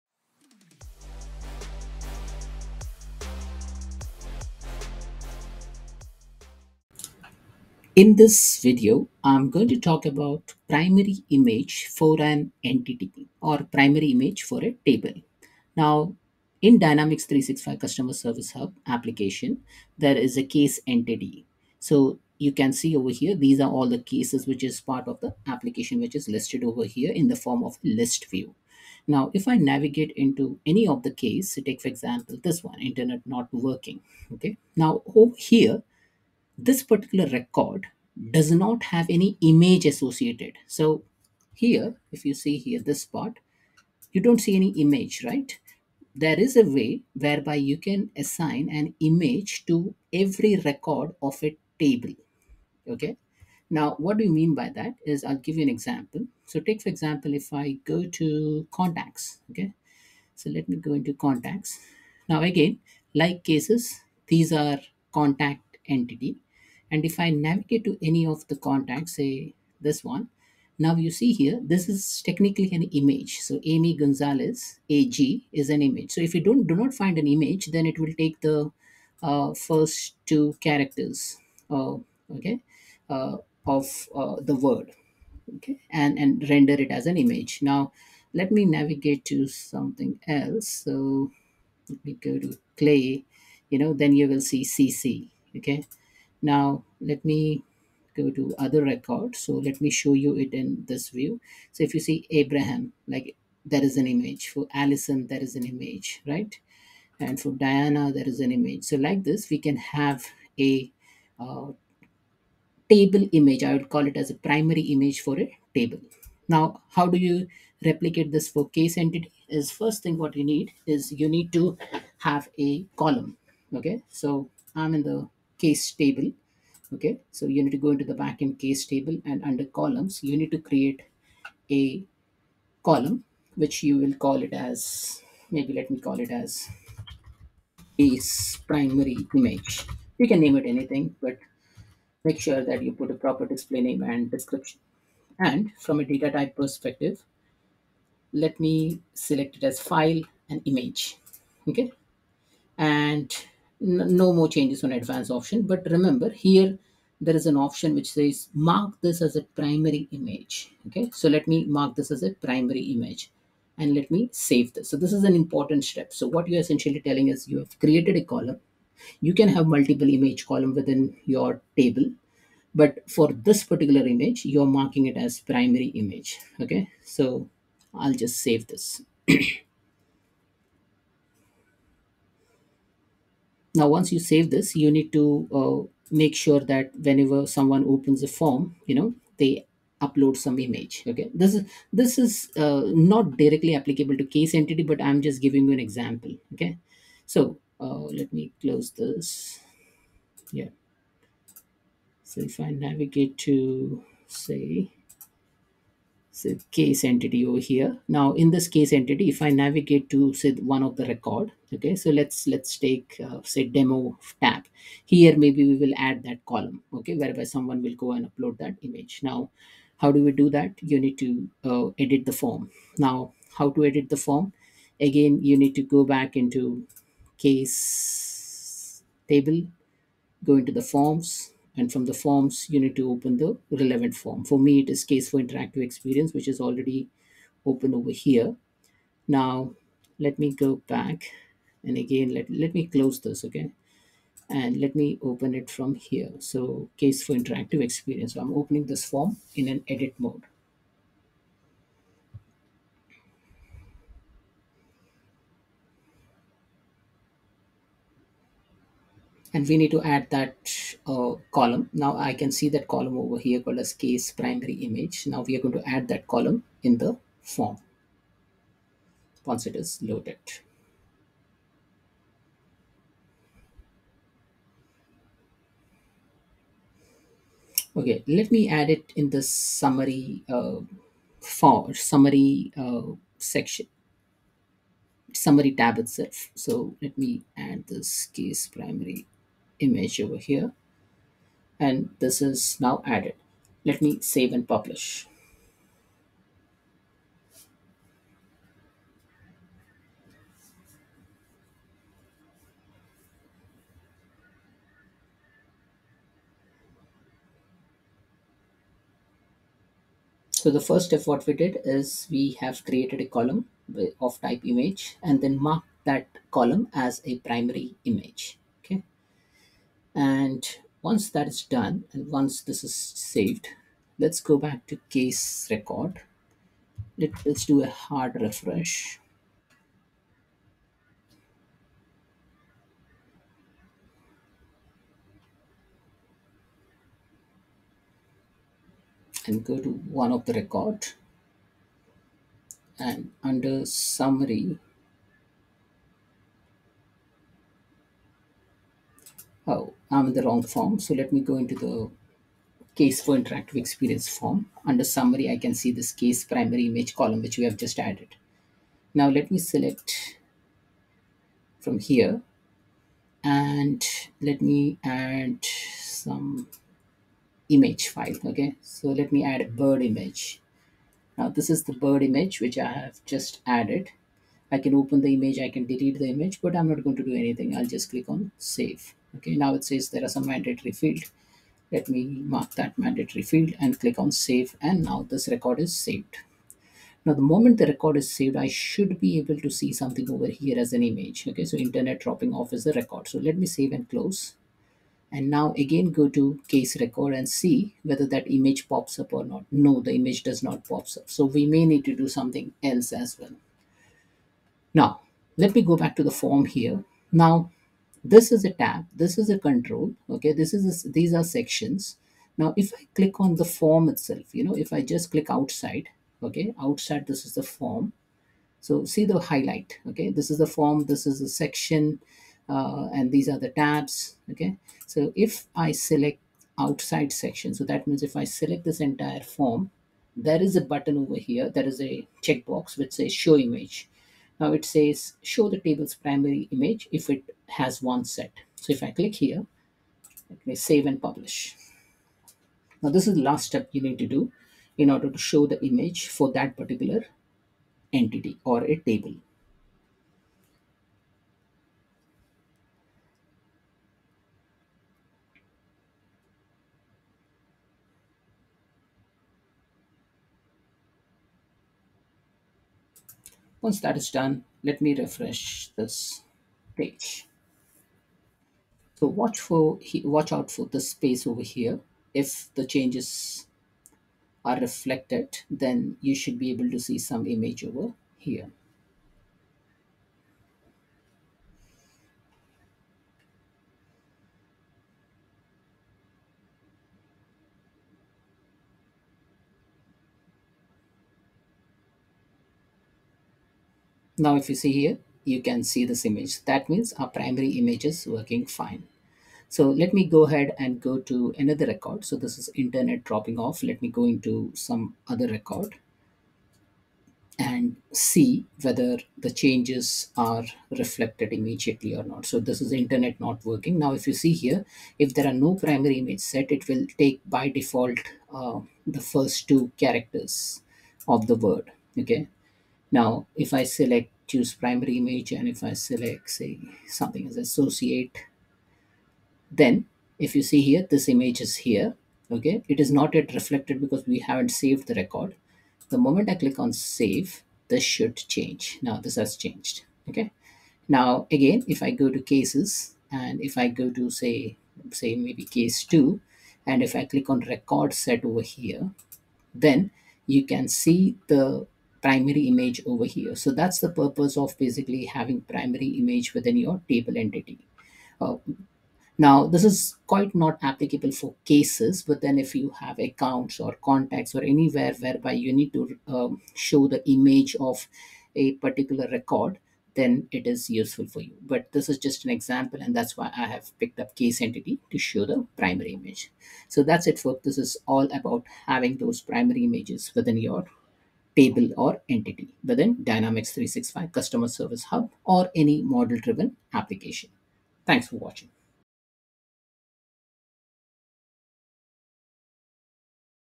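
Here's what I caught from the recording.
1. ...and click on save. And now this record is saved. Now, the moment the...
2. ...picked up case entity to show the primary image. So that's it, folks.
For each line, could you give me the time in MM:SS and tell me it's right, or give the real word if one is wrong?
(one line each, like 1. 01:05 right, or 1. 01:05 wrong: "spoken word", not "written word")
1. 06:23 right
2. 09:33 right.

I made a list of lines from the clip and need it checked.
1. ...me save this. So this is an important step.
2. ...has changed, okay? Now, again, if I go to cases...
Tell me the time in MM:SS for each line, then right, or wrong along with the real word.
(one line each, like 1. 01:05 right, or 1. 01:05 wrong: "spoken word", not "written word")
1. 02:44 right
2. 08:59 right.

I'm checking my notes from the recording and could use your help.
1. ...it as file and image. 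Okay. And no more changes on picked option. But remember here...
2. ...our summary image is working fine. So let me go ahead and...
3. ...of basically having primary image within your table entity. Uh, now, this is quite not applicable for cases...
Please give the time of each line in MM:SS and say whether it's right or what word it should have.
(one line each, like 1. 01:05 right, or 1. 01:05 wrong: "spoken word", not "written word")
1. 02:29 wrong: "advanced", not "picked"
2. 08:17 wrong: "primary", not "summary"
3. 09:14 right.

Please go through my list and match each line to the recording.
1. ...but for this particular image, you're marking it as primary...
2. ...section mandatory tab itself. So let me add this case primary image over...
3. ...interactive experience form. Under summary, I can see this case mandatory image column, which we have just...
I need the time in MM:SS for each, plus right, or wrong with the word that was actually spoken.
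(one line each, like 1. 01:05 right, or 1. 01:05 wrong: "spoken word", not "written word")
1. 02:52 right
2. 04:43 wrong: "summary", not "mandatory"
3. 05:53 wrong: "primary", not "mandatory".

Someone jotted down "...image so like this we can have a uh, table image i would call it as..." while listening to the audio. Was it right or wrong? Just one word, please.
right.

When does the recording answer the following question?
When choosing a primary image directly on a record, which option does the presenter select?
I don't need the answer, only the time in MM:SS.
08:47.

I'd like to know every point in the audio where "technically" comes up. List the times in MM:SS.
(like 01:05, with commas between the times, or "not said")
01:12.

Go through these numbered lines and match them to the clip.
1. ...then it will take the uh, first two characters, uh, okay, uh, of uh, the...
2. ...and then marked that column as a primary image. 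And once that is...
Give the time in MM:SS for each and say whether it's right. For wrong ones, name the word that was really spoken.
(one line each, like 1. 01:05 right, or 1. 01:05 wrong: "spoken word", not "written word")
1. 01:17 right
2. 05:15 right.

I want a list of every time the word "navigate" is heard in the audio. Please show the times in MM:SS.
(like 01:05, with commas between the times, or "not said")
00:29, 01:07, 01:28, 03:22, 03:29.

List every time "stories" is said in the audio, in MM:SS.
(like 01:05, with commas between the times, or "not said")
not said.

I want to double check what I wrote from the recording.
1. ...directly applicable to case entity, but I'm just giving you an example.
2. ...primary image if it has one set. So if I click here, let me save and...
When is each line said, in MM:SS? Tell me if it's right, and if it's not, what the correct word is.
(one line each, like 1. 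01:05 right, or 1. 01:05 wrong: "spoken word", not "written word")
1. 03:13 right
2. 07:16 right.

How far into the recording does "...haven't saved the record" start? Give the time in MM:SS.
08:54.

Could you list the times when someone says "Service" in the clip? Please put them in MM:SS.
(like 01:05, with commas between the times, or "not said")
00:18, 09:44.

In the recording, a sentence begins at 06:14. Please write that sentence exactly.
I can open the image, I can delete the image, but I'm not going to do anything.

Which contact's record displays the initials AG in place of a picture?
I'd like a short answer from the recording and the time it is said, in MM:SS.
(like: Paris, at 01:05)
Amy Gonzalez, at 01:13.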